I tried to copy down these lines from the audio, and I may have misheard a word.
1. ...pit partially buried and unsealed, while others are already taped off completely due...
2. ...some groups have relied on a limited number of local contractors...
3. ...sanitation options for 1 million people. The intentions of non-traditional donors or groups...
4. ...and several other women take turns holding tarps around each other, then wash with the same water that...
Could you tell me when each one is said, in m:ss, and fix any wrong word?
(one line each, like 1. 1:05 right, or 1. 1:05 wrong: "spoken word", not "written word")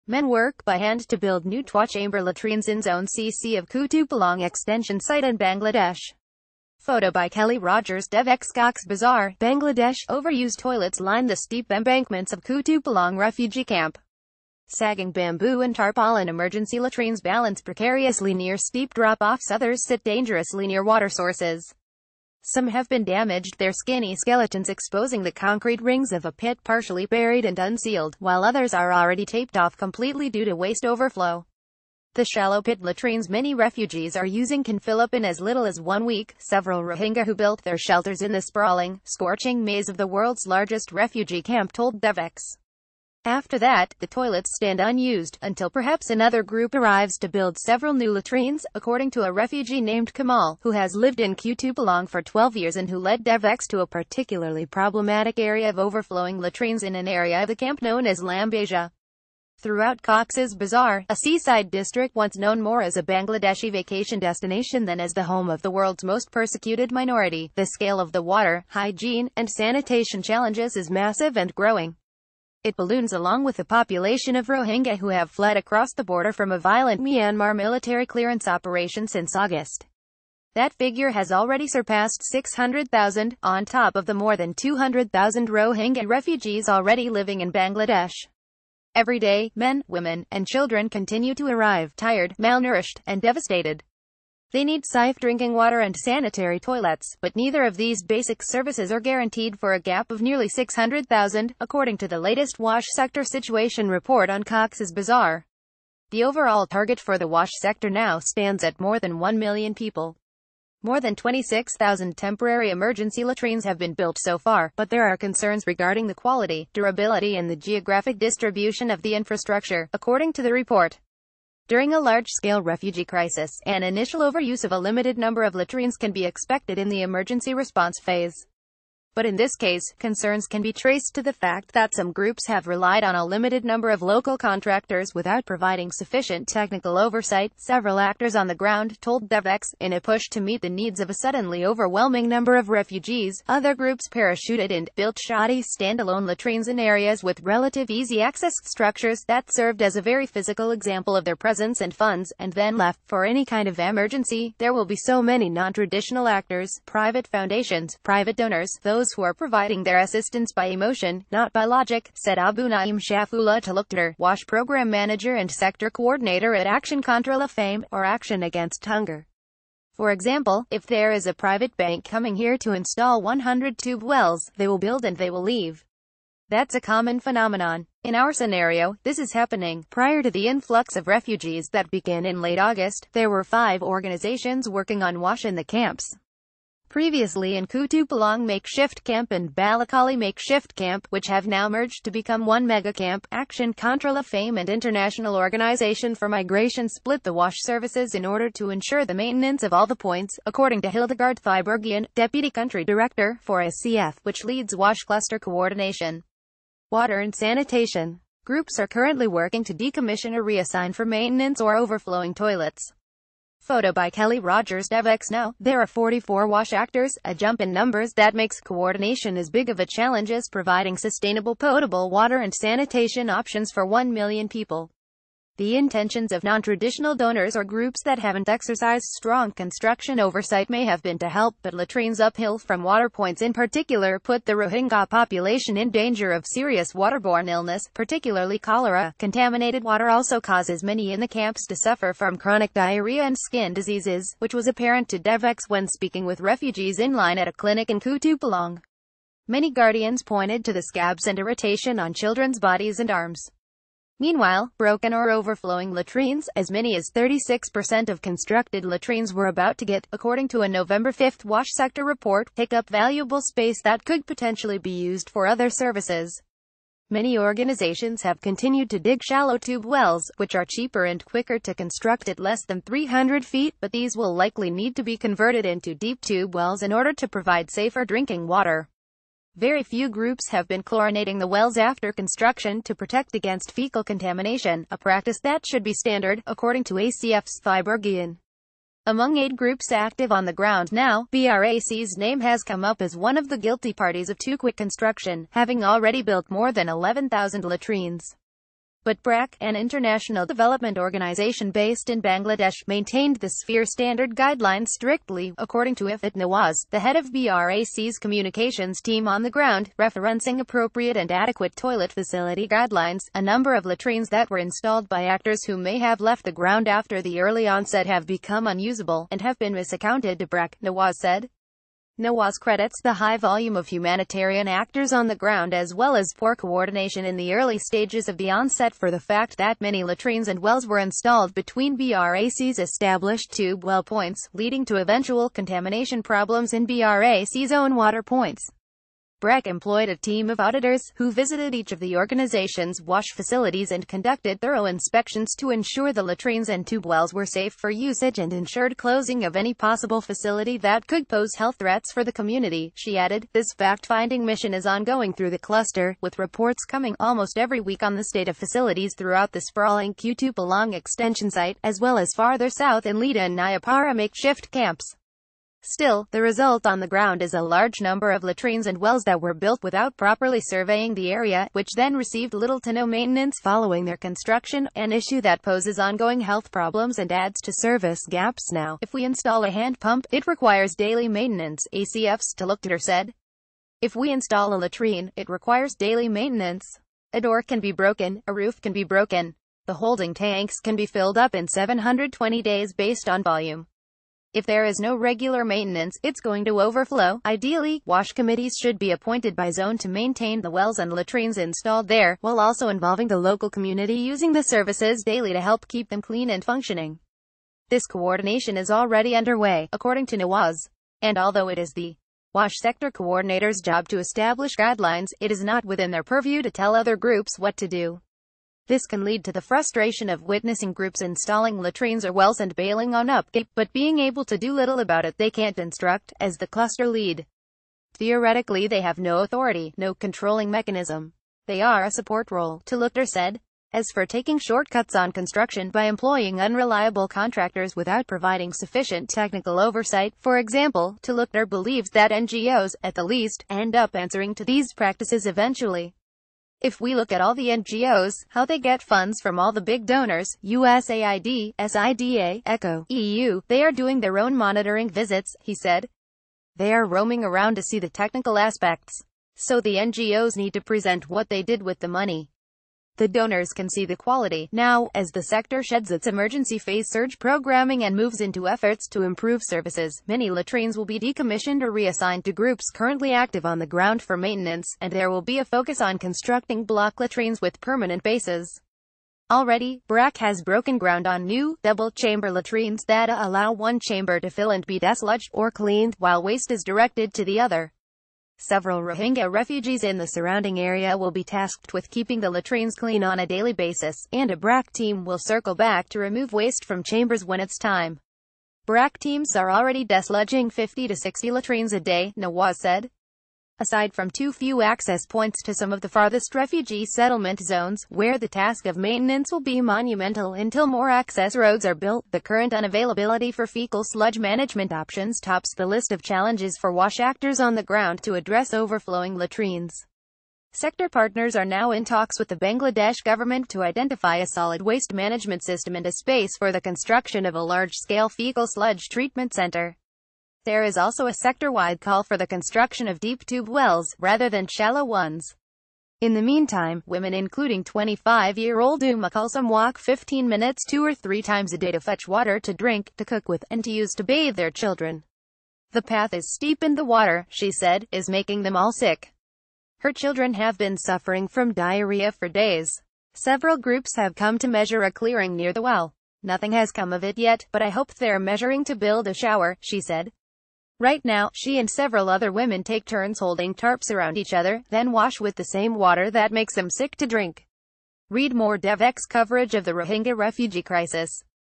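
1. 0:26 right
2. 2:11 right
3. 3:42 right
4. 9:21 right.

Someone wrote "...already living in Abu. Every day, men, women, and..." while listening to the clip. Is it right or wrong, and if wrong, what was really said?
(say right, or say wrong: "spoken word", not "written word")
wrong: "Bangladesh", not "Abu".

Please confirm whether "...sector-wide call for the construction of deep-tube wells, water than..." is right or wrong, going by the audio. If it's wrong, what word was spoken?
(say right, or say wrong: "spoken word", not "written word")
wrong: "rather", not "water".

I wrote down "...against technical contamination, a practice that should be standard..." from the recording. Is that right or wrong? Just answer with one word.
wrong.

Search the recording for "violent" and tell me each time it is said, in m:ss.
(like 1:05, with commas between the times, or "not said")
1:16.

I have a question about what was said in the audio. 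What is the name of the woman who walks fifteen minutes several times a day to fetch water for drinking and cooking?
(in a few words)
Uma Kulsum.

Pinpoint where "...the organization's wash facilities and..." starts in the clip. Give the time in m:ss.
5:41.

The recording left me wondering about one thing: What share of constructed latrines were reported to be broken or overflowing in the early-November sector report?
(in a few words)
36%.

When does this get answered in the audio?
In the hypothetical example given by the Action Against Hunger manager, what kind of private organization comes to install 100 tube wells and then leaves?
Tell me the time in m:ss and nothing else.
2:51.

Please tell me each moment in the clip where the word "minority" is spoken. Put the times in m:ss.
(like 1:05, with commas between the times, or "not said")
1:06.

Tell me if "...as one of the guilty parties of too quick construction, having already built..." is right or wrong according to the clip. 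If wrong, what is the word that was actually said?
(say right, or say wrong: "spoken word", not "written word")
right.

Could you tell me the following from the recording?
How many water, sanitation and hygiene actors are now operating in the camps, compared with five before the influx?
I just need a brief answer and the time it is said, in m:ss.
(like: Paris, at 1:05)
44, at 3:35.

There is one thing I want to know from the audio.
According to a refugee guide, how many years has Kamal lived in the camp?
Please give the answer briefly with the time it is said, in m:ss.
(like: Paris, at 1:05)
12 years, at 0:52.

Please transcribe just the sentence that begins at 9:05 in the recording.
The path is steep and the water, she said, is making them all sick.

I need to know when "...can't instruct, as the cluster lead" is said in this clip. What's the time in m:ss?
7:05.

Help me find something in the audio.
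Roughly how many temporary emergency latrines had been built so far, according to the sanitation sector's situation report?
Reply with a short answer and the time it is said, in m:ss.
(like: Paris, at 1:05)
26,000, at 1:51.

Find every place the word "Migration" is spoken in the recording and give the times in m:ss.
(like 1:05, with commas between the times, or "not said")
3:16.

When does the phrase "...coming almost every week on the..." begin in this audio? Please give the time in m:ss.
5:56.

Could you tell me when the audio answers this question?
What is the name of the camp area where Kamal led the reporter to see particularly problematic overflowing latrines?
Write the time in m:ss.
0:58.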